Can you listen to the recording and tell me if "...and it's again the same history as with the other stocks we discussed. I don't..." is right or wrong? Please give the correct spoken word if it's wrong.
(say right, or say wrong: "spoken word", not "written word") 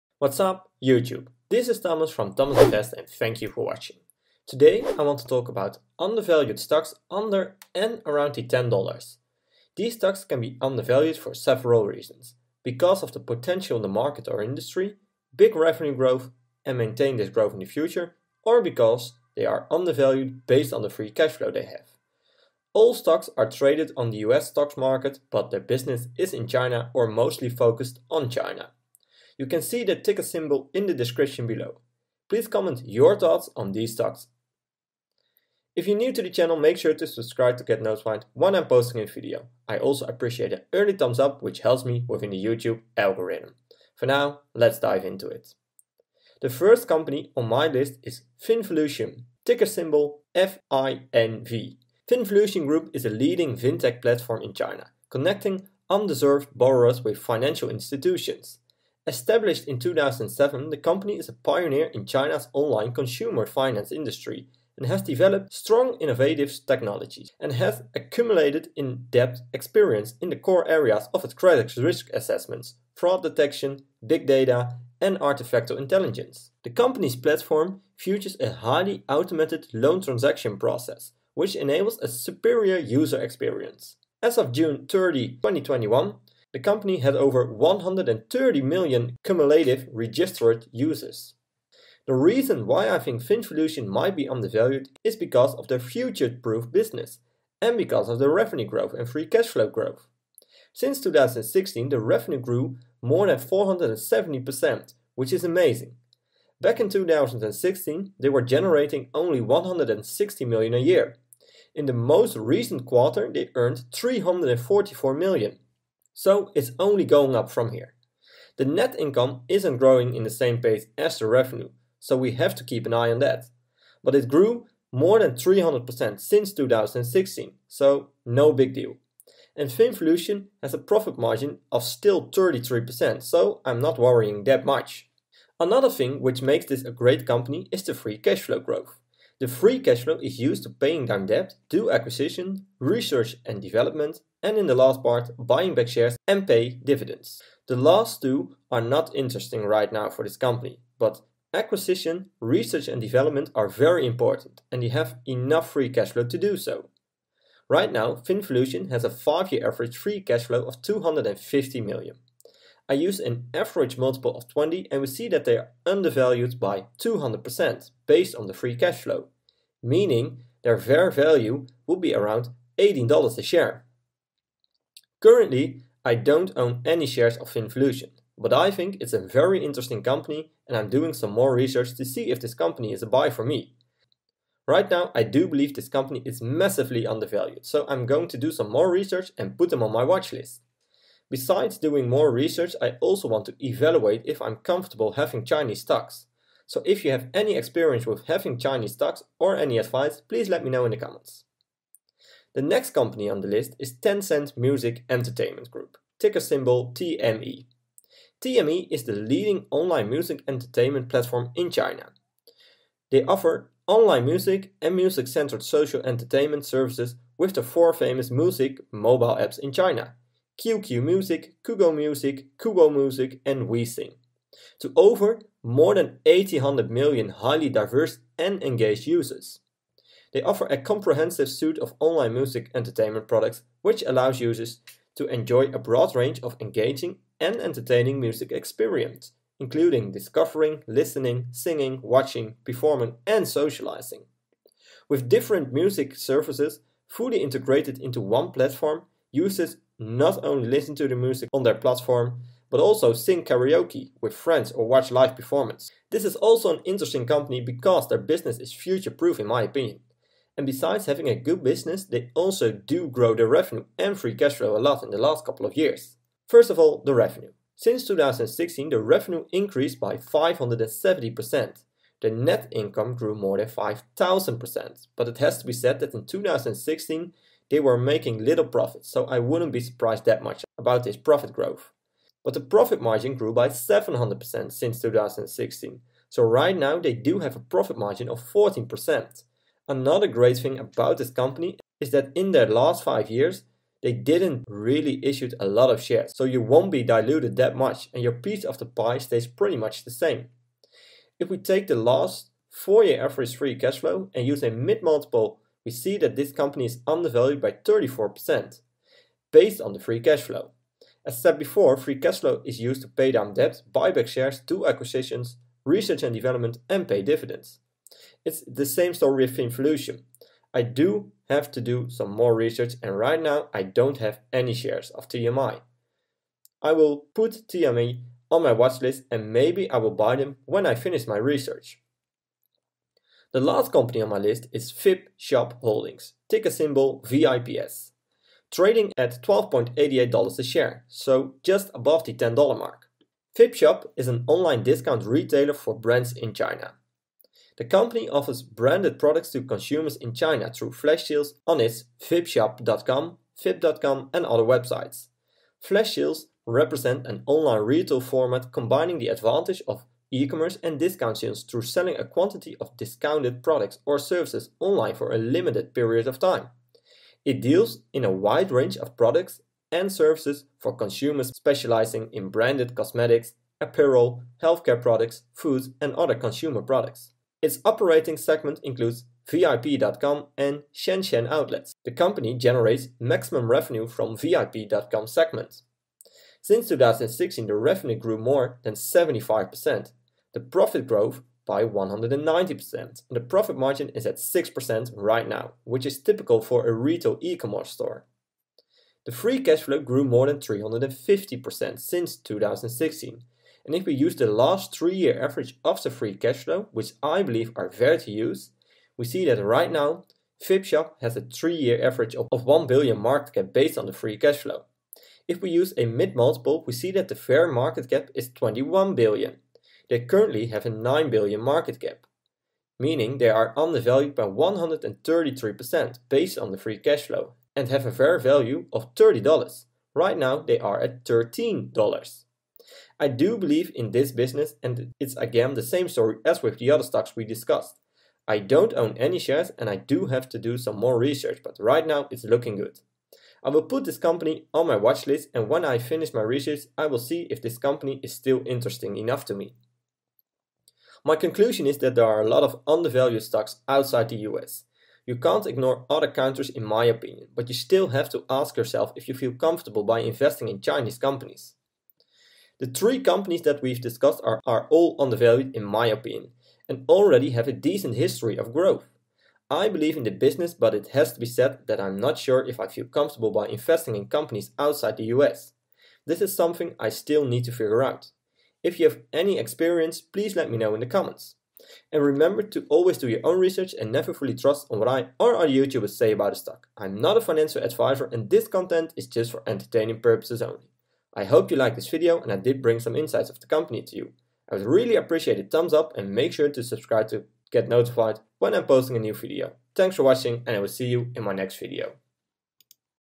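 wrong: "story", not "history".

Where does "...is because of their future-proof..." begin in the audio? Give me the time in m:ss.
1:35.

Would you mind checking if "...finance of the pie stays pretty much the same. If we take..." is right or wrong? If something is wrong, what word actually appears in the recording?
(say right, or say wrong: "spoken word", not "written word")
wrong: "piece", not "finance".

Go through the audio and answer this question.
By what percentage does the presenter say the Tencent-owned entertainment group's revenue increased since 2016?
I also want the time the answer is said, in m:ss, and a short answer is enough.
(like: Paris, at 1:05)
570%, at 4:30.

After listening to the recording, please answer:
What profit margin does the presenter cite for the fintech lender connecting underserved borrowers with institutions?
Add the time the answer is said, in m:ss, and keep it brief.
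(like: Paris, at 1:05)
33%, at 2:12.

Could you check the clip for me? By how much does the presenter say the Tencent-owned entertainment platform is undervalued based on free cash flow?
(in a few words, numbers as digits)
34%.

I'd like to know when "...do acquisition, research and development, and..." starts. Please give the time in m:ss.
2:21.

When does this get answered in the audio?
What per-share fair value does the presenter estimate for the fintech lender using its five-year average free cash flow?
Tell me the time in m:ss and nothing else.
2:52.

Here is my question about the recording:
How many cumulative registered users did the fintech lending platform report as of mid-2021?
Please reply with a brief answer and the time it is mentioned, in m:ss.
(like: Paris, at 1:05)
over 130 million, at 1:27.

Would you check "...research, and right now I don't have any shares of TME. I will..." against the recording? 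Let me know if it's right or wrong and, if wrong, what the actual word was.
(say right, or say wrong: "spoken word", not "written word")
right.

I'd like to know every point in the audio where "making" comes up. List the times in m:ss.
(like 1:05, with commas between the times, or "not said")
4:37.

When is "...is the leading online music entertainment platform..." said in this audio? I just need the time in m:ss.
3:28.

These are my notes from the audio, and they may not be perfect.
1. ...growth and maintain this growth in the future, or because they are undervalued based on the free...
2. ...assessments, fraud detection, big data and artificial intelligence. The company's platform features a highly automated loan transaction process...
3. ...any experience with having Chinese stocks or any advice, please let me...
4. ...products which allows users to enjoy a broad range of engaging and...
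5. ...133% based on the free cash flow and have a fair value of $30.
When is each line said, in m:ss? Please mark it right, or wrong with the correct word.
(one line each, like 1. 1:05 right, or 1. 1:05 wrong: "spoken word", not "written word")
1. 0:15 right
2. 1:12 right
3. 3:17 right
4. 3:53 right
5. 7:04 right.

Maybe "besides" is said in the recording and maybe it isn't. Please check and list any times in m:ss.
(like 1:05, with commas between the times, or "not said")
3:11, 4:20.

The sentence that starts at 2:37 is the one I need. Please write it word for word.
Right now, Finvolution has a 5-year average free cash flow of 250 million.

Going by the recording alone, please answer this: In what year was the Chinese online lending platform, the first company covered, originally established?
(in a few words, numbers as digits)
2007.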